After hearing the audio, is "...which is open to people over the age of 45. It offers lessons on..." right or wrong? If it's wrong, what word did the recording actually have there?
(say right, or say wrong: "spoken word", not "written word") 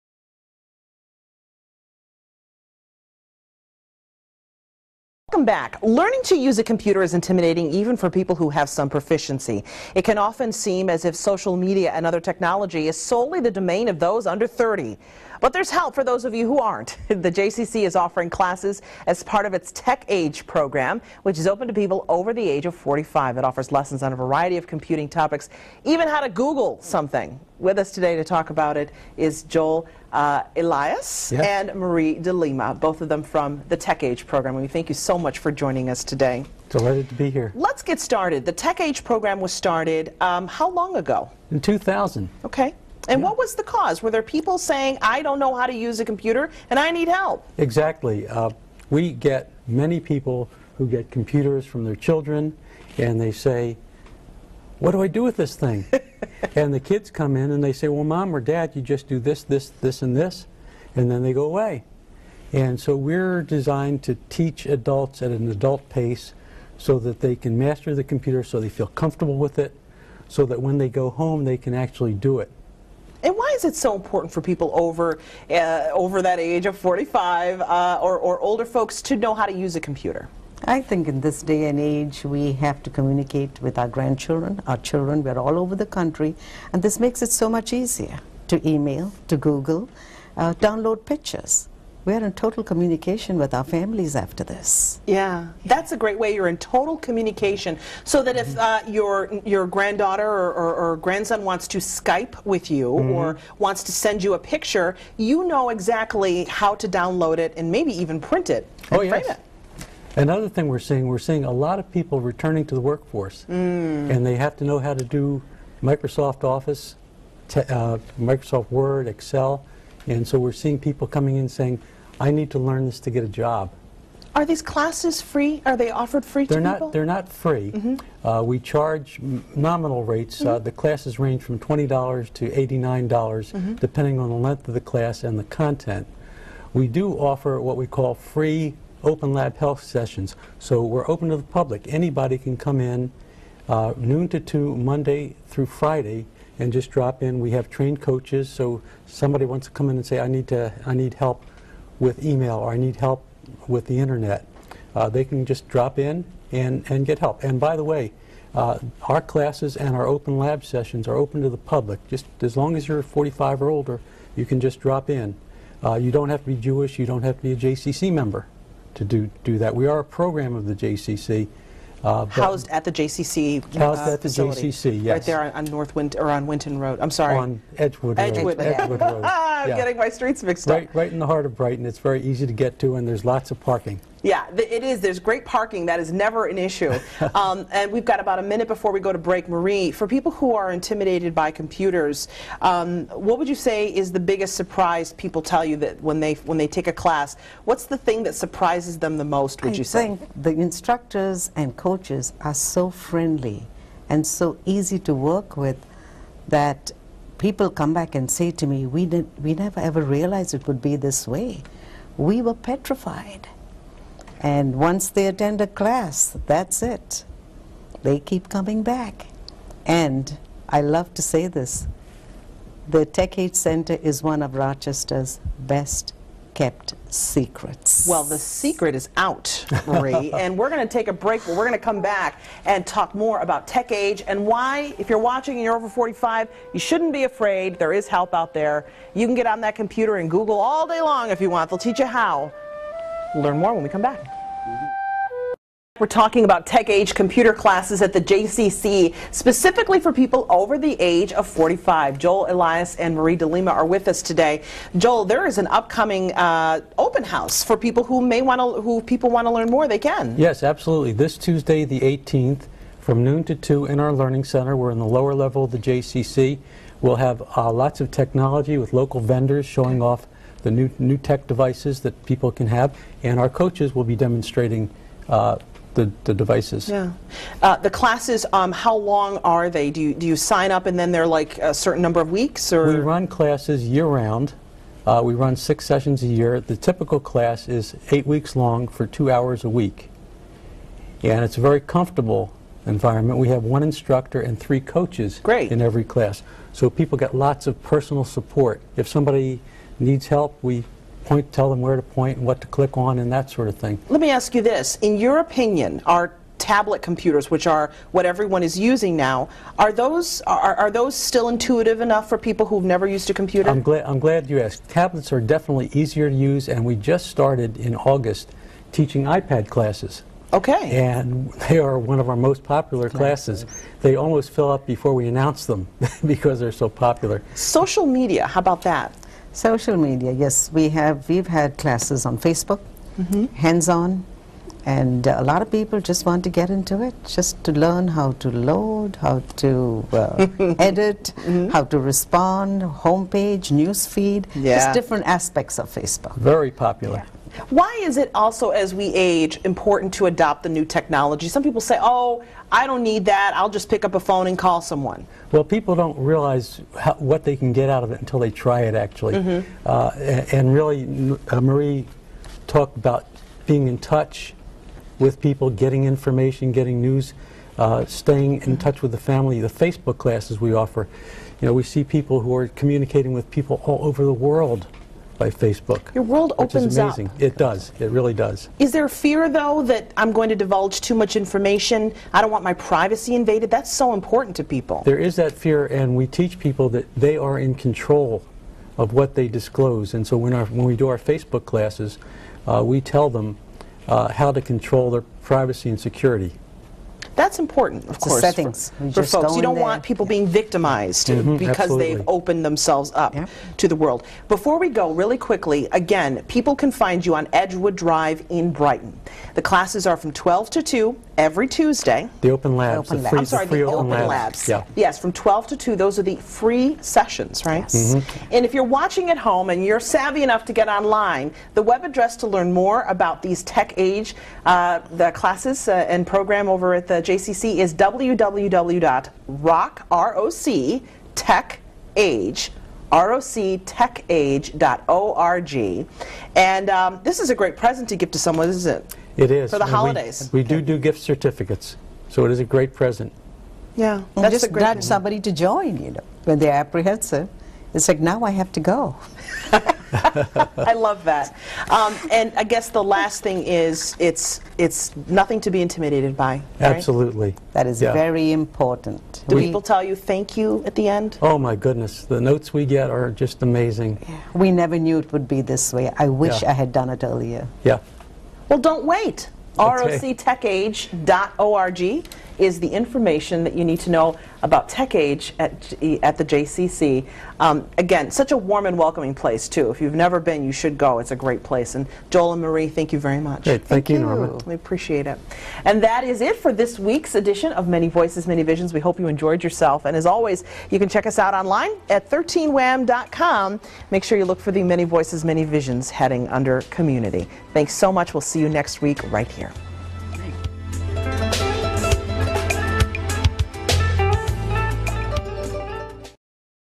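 right.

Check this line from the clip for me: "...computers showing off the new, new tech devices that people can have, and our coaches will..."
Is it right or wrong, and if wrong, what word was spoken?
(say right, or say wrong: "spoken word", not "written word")
wrong: "vendors", not "computers".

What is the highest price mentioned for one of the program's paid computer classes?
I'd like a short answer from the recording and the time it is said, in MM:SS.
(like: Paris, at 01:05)
$89, at 02:12.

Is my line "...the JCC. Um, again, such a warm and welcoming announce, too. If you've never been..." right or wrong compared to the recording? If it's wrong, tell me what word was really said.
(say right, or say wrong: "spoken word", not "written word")
wrong: "place", not "announce".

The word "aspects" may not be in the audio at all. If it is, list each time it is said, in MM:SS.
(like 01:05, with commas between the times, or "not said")
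05:45.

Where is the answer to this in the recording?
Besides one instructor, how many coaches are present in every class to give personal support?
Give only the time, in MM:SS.
04:54.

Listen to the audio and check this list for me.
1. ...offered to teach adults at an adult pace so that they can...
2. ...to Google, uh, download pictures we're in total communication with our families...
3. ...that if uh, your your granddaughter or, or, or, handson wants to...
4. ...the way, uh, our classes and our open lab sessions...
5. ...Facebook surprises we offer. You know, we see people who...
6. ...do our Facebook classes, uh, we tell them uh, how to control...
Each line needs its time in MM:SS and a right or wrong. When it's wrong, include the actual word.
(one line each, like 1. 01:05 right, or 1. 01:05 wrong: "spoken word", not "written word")
1. 01:03 wrong: "designed", not "offered"
2. 01:29 right
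3. 01:38 wrong: "grandson", not "handson"
4. 02:37 right
5. 06:09 wrong: "classes", not "surprises"
6. 06:30 right.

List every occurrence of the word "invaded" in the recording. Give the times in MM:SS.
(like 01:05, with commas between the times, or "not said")
06:23.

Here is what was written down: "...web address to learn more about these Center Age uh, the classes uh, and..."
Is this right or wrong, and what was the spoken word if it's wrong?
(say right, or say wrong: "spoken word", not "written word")
wrong: "Tech", not "Center".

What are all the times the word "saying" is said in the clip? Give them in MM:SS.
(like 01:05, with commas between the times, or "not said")
00:44, 02:01.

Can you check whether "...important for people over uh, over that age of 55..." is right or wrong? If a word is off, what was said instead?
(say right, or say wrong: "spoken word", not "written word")
wrong: "45", not "55".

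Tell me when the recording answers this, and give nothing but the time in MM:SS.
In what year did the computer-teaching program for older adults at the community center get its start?
00:41.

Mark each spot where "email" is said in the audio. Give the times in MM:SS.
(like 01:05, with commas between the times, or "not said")
01:28, 02:32.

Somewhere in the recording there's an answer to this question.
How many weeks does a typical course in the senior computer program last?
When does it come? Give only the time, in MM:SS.
04:48.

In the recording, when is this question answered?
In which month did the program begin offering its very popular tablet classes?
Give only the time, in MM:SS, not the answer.
05:17.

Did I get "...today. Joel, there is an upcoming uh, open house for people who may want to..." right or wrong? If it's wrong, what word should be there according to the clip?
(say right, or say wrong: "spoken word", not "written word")
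right.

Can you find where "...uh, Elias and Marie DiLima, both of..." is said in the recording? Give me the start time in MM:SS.
00:30.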